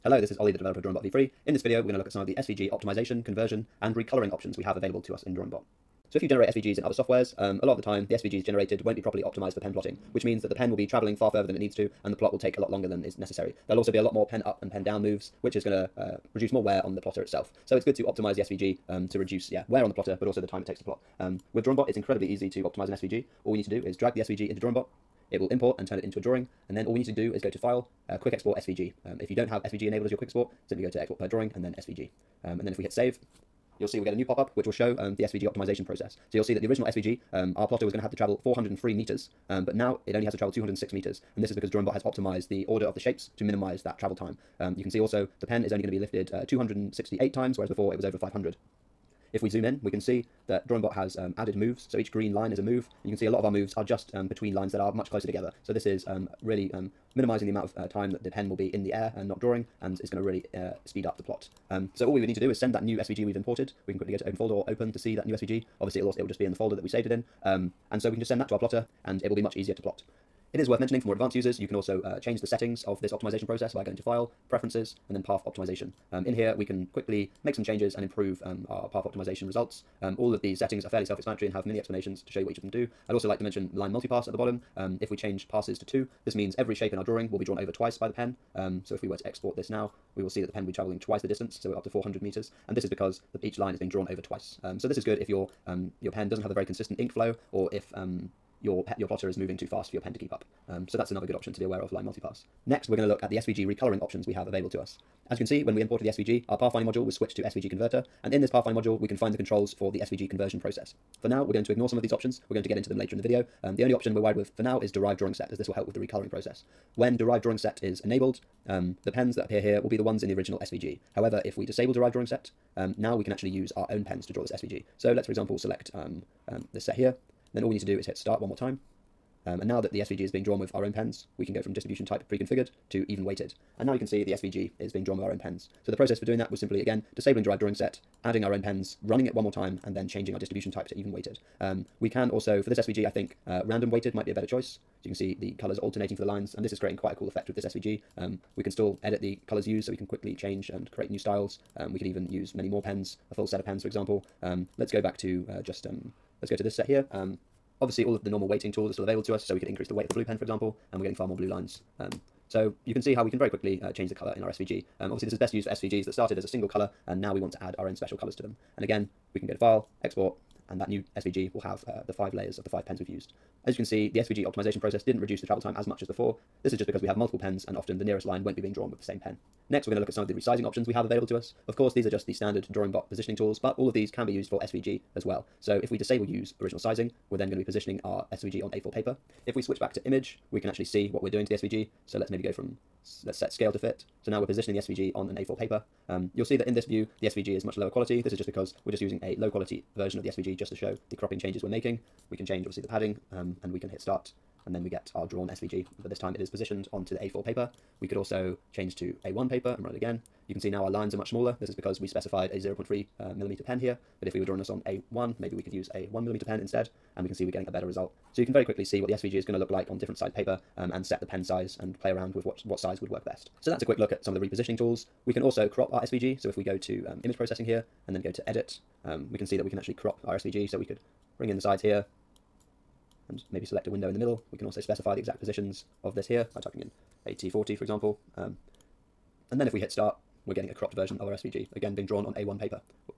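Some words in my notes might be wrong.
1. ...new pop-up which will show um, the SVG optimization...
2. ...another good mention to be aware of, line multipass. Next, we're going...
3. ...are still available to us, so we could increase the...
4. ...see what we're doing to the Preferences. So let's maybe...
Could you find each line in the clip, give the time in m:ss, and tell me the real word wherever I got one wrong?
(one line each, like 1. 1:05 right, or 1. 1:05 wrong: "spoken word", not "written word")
1. 0:34 right
2. 1:41 wrong: "option", not "mention"
3. 2:38 right
4. 3:10 wrong: "SVG", not "Preferences".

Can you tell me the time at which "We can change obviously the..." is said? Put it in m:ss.
3:22.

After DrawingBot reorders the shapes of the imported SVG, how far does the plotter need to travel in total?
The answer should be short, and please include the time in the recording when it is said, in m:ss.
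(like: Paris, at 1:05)
206 meters, at 0:40.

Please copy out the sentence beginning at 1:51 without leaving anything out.
For now, we're going to ignore some of these options.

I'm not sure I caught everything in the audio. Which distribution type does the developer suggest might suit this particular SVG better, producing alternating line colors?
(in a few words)
random weighted.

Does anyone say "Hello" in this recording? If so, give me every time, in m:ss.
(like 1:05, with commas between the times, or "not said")
0:00.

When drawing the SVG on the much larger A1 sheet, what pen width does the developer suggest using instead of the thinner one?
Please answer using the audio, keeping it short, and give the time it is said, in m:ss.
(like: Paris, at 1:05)
1 millimeter, at 3:36.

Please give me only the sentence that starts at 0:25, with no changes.
It will import and turn it into a drawing.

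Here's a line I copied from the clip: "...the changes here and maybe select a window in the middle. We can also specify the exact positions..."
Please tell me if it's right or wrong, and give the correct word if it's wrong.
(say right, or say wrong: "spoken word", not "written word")
wrong: "sides", not "changes".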